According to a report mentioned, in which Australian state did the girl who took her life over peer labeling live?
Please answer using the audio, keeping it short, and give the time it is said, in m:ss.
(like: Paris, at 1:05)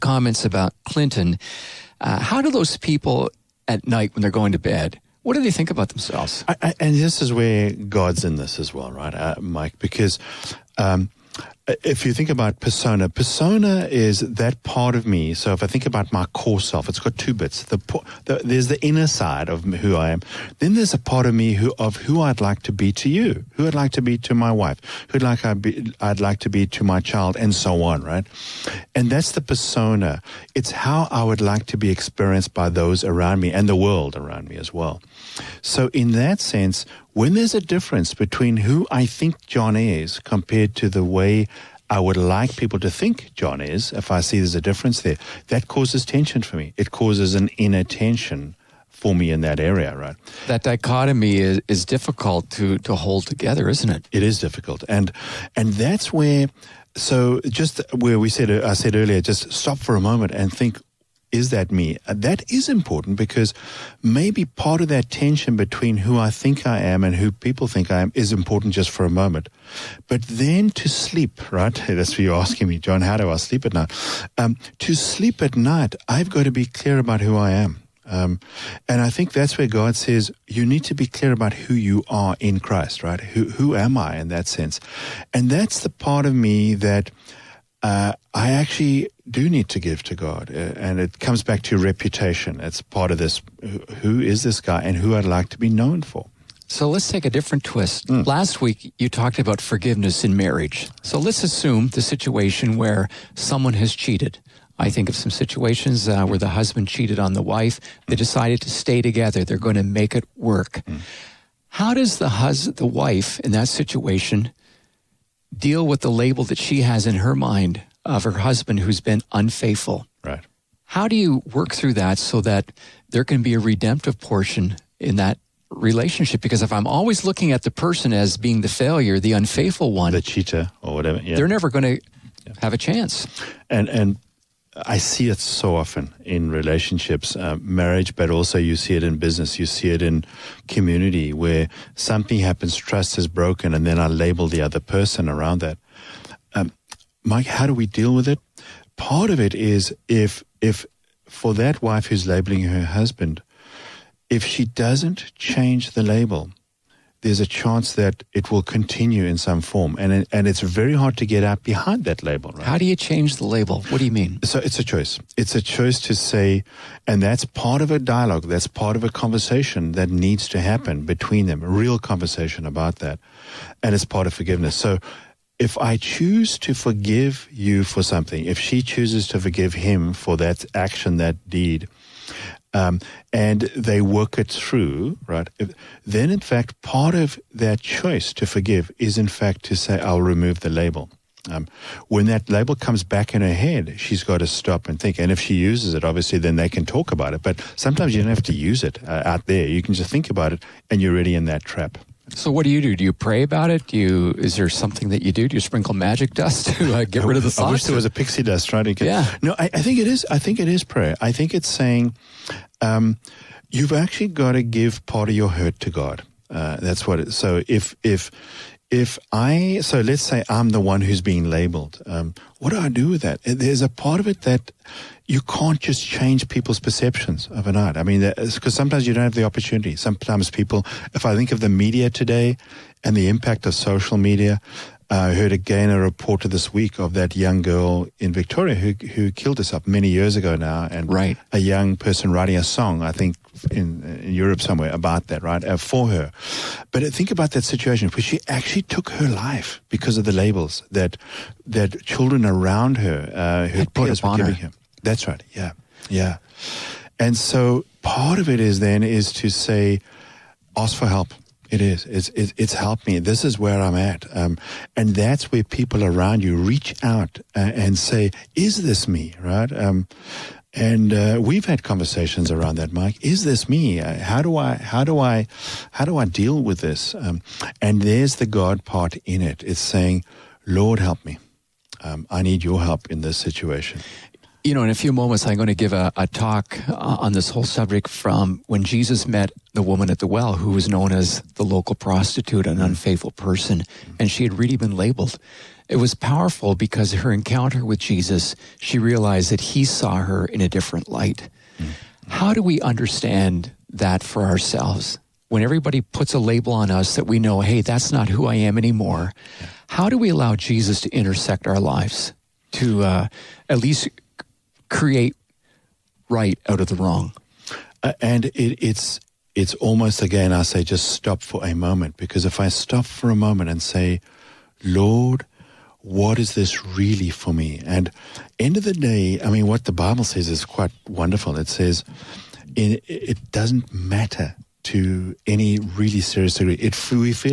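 Victoria, at 3:58.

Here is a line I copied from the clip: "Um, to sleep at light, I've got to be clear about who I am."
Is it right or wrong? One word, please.
wrong.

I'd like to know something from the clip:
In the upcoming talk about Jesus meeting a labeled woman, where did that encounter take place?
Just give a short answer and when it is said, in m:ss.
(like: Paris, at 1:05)
At the well, at 4:50.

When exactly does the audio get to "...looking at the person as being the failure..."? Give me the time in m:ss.
2:07.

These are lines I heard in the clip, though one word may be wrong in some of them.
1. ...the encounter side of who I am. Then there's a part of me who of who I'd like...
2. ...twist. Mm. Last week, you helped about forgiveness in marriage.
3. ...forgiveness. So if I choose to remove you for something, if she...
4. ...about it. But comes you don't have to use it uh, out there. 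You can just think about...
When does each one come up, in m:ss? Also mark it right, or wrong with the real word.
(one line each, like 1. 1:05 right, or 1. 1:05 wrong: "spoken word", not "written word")
1. 0:18 wrong: "inner", not "encounter"
2. 1:37 wrong: "talked", not "helped"
3. 2:54 wrong: "forgive", not "remove"
4. 3:17 wrong: "sometimes", not "comes".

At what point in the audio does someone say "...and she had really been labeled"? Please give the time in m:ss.
4:54.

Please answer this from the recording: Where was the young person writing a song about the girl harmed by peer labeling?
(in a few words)
Europe.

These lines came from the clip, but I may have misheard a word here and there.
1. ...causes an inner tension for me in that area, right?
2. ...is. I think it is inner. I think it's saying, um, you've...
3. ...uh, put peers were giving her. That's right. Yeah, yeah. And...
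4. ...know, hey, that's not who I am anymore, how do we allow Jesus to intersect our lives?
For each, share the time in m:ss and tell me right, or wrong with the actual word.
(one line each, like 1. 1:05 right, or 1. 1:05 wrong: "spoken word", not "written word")
1. 0:46 right
2. 3:30 wrong: "prayer", not "inner"
3. 4:13 right
4. 5:07 right.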